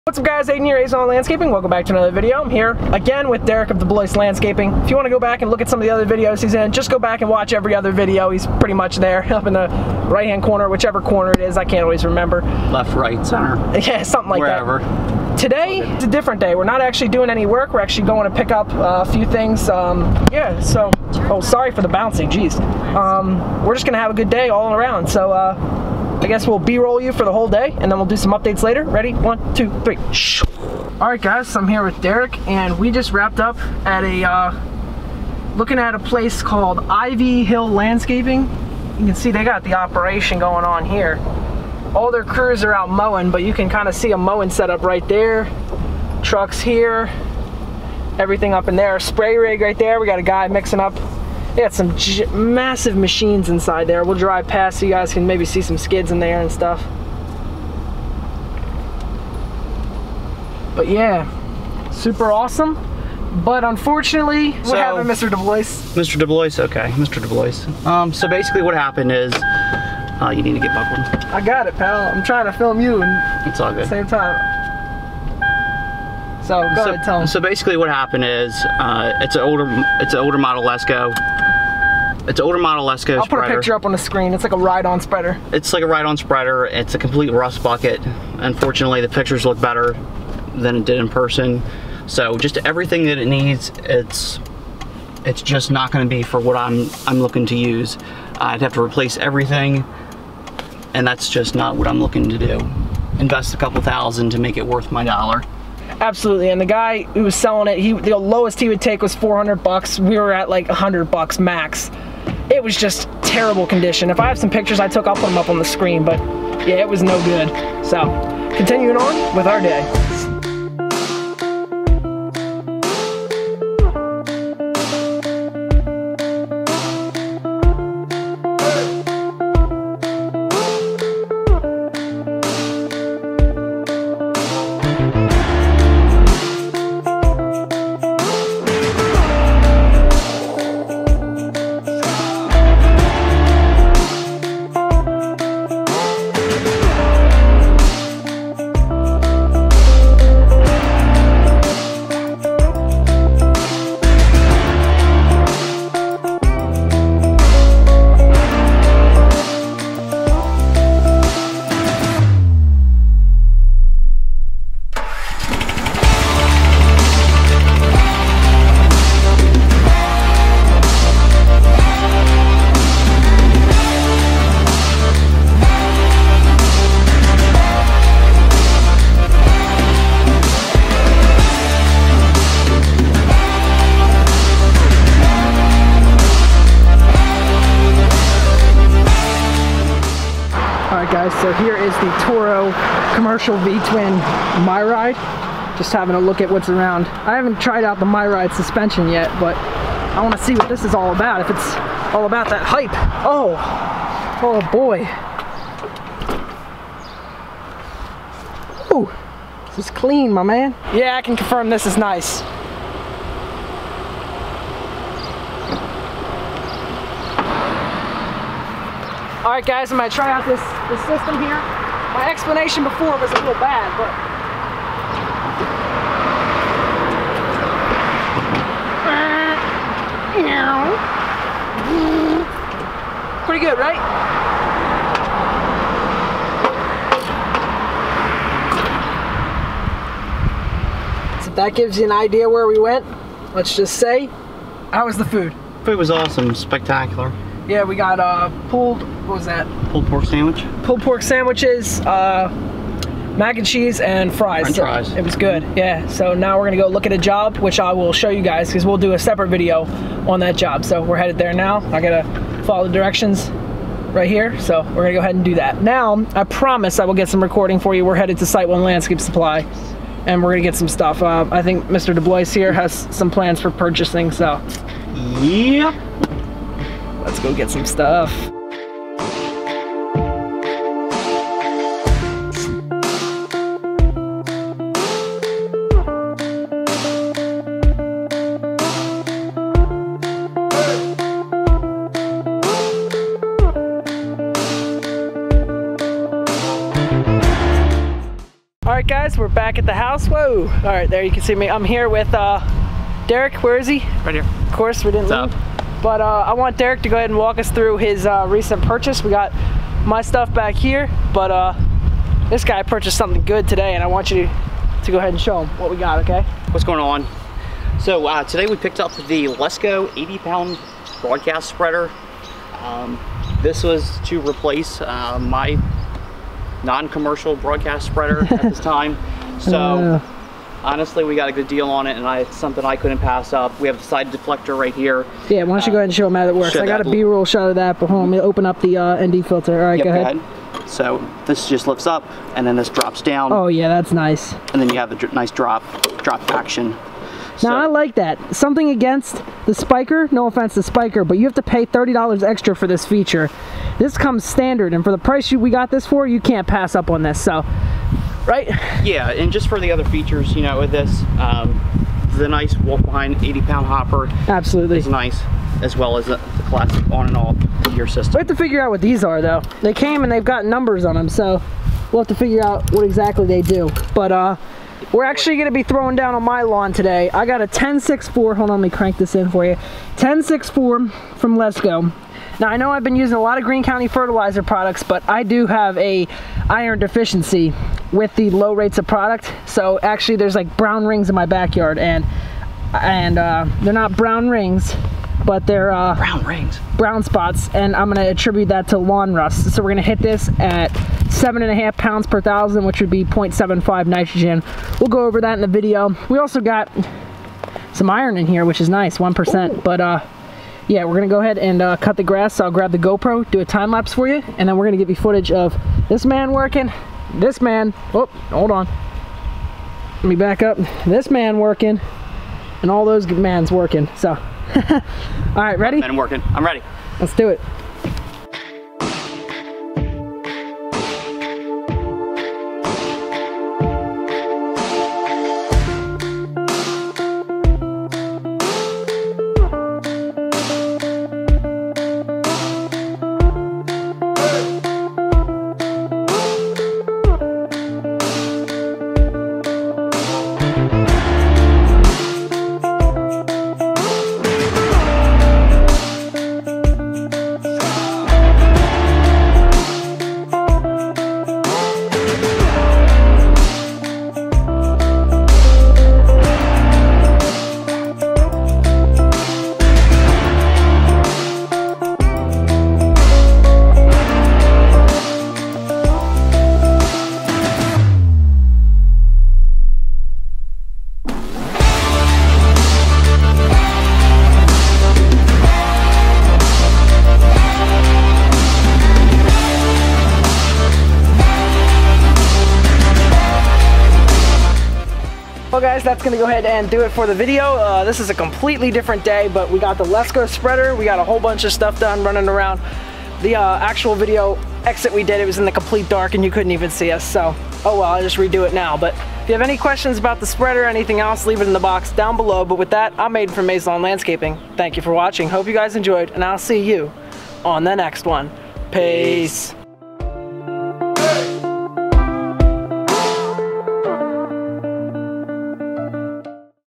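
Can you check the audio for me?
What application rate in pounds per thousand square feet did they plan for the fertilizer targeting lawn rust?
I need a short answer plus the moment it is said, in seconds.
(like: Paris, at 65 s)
7.5, at 401 s.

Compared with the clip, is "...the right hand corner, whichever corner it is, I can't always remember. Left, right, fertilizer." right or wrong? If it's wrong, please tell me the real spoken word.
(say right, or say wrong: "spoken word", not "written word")
wrong: "center", not "fertilizer".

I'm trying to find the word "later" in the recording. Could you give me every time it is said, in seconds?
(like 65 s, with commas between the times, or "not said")
28 s.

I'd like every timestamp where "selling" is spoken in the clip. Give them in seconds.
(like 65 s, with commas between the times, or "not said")
107 s.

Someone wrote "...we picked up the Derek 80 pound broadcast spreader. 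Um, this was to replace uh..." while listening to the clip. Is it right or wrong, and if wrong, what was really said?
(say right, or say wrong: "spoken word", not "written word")
wrong: "Lesco", not "Derek".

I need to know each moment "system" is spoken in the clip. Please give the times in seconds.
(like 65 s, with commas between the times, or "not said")
221 s, 368 s.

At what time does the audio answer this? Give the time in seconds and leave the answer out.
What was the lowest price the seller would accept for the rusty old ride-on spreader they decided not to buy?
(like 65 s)
109 s.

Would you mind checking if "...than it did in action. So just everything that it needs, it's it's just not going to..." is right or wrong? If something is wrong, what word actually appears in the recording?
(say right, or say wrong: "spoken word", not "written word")
wrong: "person", not "action".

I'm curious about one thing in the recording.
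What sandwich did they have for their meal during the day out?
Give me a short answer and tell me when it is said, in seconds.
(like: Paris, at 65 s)
Pulled pork sandwich, at 249 s.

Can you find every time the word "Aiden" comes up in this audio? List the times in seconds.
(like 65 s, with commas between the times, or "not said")
0 s, 513 s.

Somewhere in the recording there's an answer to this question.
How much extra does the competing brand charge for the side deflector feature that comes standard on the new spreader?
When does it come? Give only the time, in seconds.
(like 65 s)
351 s.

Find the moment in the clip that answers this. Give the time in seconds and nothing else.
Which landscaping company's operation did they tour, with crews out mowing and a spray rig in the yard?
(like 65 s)
36 s.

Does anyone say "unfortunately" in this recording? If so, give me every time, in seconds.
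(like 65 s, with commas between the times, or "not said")
63 s, 88 s.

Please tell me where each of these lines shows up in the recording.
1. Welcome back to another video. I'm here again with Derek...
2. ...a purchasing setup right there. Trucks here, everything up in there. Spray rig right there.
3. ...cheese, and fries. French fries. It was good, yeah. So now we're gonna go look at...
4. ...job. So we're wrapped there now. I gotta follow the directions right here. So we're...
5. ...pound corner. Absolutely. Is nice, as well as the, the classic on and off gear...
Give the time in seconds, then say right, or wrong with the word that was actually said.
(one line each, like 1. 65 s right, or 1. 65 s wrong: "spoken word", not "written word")
1. 1 s right
2. 44 s wrong: "mowing", not "purchasing"
3. 253 s right
4. 260 s wrong: "headed", not "wrapped"
5. 363 s wrong: "hopper", not "corner".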